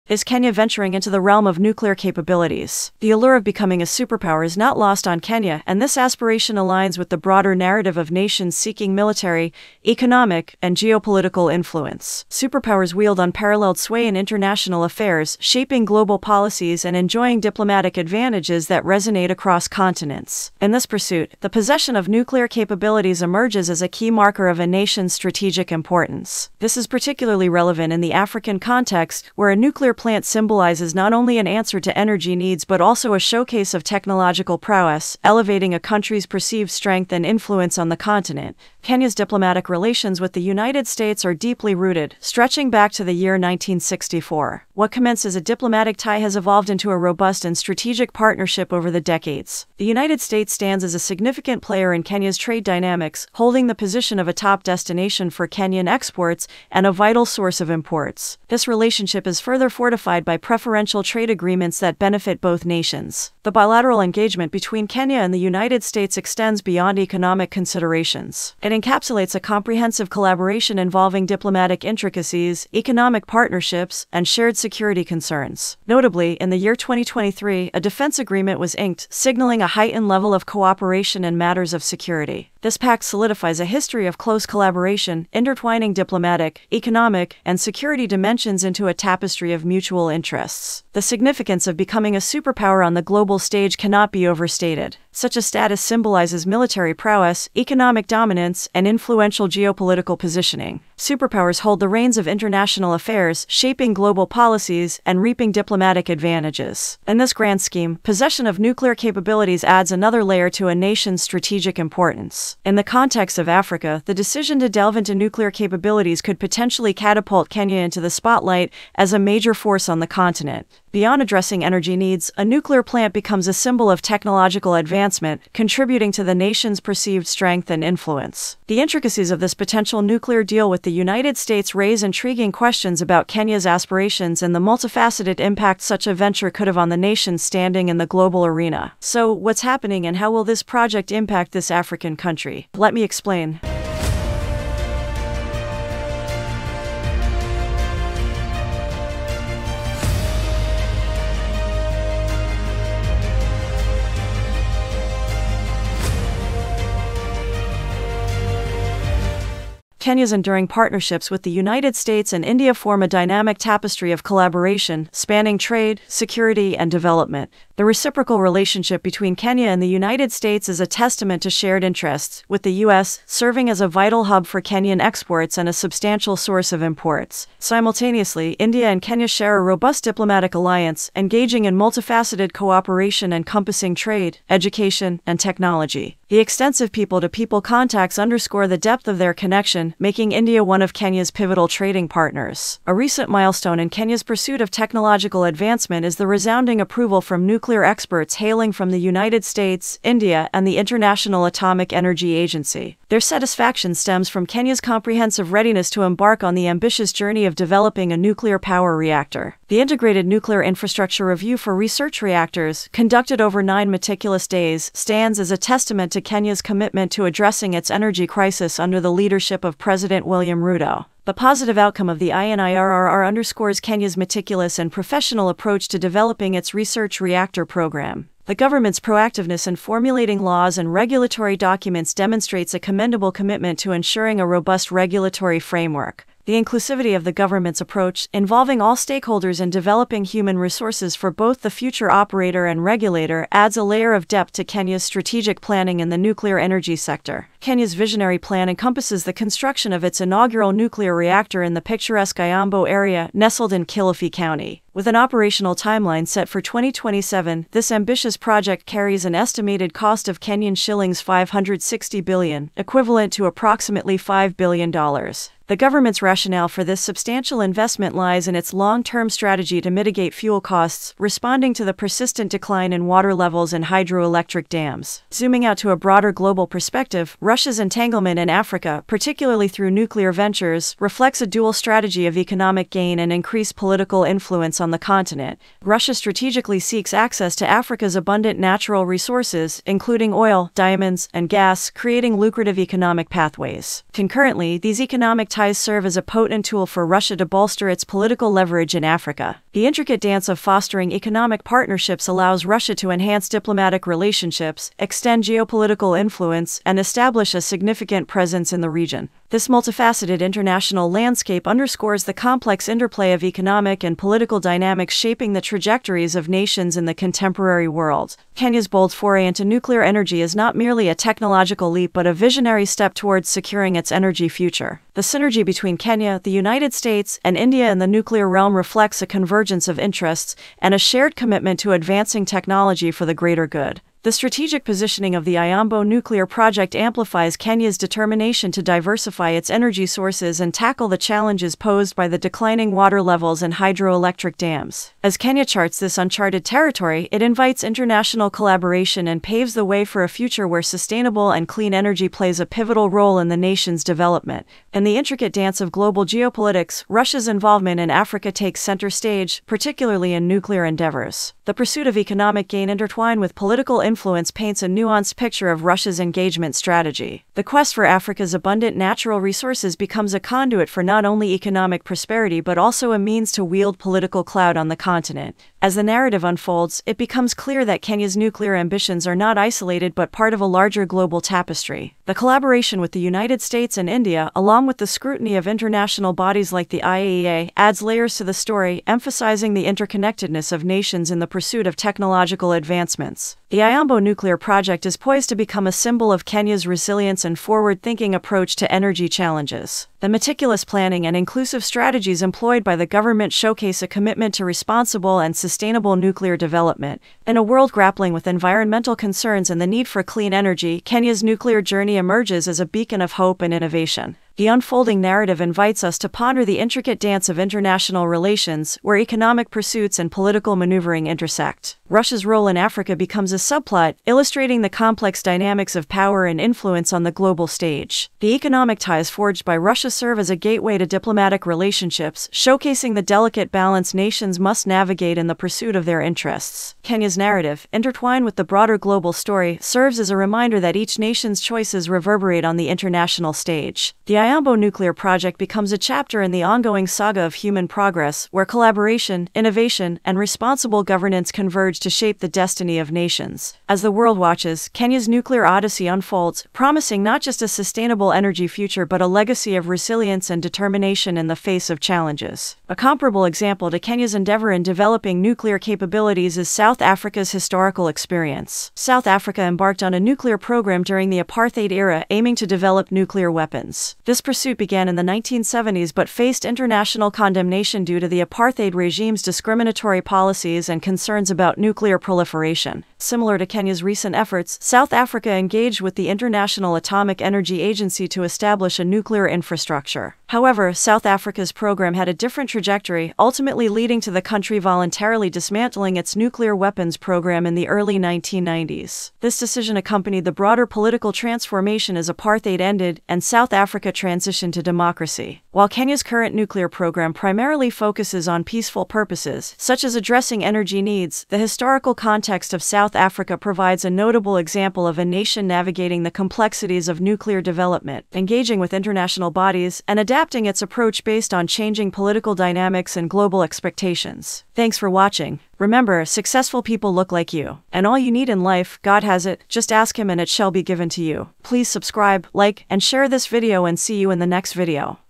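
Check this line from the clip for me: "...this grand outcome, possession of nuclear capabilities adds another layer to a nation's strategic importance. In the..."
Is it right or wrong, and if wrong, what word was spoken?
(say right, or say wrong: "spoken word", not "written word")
wrong: "scheme", not "outcome".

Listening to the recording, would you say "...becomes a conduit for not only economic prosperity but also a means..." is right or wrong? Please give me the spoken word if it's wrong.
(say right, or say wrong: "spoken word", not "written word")
right.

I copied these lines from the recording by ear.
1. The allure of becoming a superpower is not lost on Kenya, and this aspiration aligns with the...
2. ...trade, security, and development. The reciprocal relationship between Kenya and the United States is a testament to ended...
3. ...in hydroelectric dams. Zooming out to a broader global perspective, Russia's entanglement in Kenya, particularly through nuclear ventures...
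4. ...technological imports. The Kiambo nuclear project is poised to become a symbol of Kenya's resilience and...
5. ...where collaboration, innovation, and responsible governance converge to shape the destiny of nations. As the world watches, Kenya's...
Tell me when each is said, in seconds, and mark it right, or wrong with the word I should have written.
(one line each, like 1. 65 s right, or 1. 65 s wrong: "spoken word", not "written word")
1. 2 s right
2. 165 s wrong: "shared", not "ended"
3. 273 s wrong: "Africa", not "Kenya"
4. 391 s wrong: "advancements", not "imports"
5. 448 s right.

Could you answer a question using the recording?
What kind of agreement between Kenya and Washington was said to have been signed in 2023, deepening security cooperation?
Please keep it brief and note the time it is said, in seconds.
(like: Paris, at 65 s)
defense agreement, at 77 s.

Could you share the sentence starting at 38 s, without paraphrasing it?
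Kenya's diplomatic relations with the United States are deeply rooted, stretching back to the year 1964.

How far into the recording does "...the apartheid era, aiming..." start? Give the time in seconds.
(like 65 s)
471 s.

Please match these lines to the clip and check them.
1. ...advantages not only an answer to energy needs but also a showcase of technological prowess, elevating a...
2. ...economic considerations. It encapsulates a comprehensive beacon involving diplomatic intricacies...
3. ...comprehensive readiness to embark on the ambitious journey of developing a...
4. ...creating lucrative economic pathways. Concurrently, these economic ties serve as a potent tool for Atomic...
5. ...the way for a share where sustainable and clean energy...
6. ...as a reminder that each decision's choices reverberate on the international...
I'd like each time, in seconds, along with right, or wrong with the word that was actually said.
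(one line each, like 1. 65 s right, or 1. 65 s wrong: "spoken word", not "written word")
1. 30 s wrong: "symbolizes", not "advantages"
2. 66 s wrong: "collaboration", not "beacon"
3. 204 s right
4. 291 s wrong: "Russia", not "Atomic"
5. 349 s wrong: "future", not "share"
6. 440 s wrong: "nation", not "decision".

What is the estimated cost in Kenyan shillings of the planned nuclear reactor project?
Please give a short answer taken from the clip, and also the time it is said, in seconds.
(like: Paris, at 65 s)
560 billion shillings, at 260 s.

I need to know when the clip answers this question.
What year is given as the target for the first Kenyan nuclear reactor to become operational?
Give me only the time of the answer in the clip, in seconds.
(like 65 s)
256 s.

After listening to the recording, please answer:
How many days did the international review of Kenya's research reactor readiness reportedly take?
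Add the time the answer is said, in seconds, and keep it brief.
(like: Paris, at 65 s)
nine, at 213 s.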